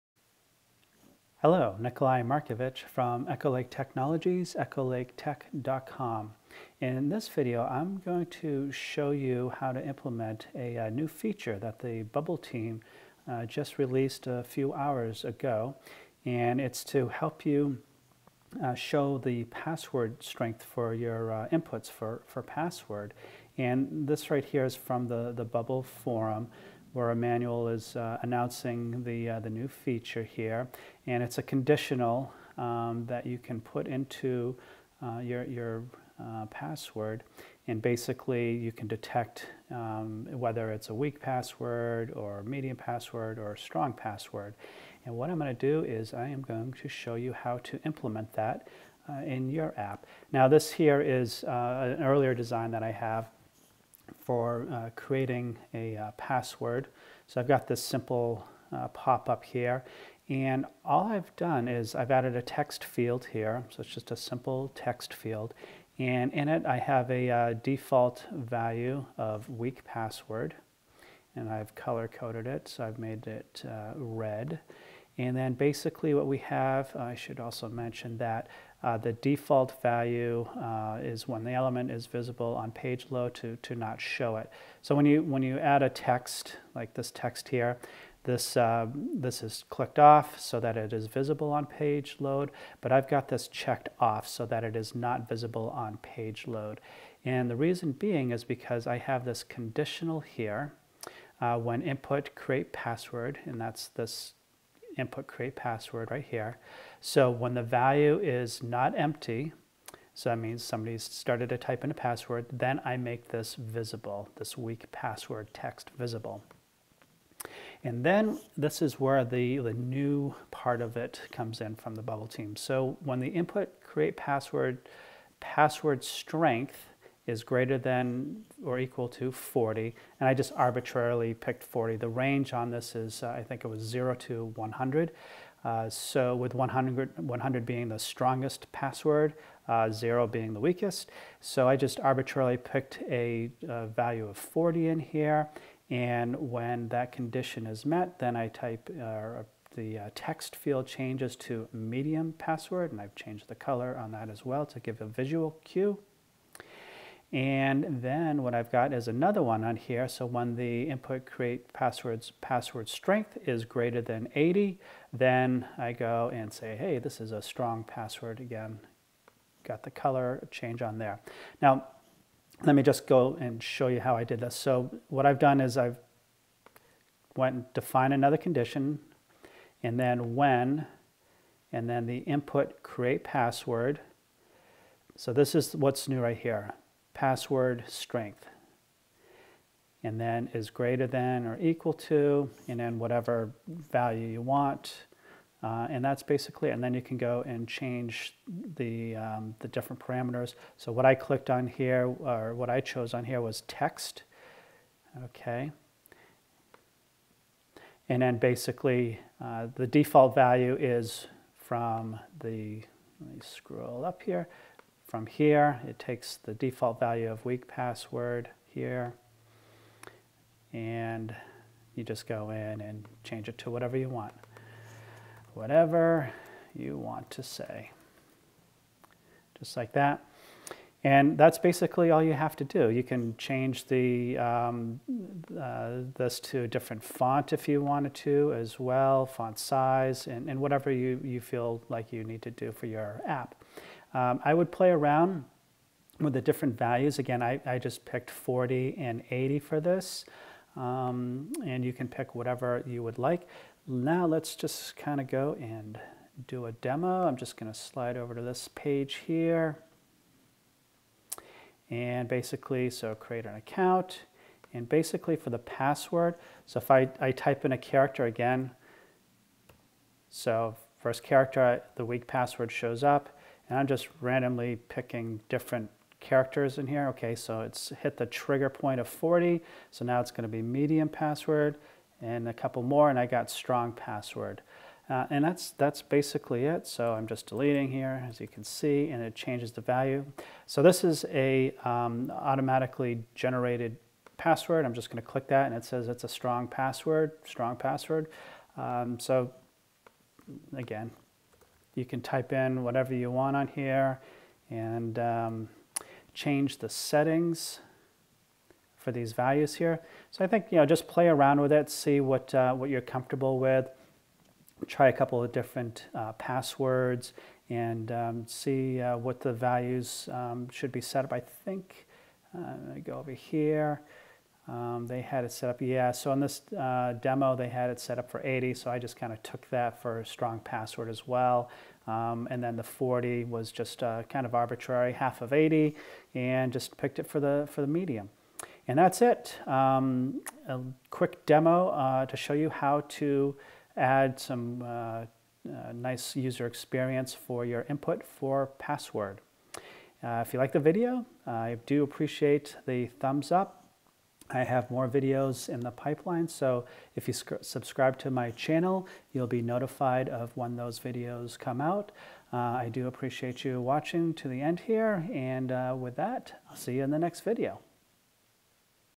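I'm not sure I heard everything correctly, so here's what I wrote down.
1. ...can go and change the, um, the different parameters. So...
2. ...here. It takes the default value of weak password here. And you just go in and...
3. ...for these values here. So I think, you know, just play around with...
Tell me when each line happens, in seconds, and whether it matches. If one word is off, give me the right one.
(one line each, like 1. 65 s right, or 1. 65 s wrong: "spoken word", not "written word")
1. 197 s right
2. 215 s right
3. 308 s right.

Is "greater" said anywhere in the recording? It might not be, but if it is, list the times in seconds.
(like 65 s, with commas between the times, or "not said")
127 s, 163 s, 190 s.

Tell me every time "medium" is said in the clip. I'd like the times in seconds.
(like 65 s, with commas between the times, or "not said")
42 s, 151 s, 280 s, 337 s.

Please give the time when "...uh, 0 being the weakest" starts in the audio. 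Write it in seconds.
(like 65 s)
139 s.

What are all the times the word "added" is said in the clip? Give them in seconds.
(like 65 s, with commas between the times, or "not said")
62 s.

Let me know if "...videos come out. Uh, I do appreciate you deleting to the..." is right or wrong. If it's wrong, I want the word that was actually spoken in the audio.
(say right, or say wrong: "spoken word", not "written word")
wrong: "watching", not "deleting".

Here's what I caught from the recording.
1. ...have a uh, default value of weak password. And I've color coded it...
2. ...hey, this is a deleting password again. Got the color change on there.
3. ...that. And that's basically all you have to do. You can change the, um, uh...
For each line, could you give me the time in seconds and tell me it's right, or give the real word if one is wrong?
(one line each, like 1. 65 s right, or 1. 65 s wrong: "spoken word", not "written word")
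1. 66 s right
2. 166 s wrong: "strong", not "deleting"
3. 229 s right.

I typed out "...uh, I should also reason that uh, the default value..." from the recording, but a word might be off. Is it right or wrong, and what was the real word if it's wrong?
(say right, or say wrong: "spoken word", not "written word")
wrong: "mention", not "reason".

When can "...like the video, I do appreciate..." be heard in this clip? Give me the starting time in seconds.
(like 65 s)
350 s.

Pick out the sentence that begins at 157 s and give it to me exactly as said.
And then what I've got is another one on here.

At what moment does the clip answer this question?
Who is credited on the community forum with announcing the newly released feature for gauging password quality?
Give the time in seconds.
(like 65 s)
27 s.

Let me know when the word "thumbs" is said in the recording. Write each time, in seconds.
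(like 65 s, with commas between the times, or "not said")
353 s.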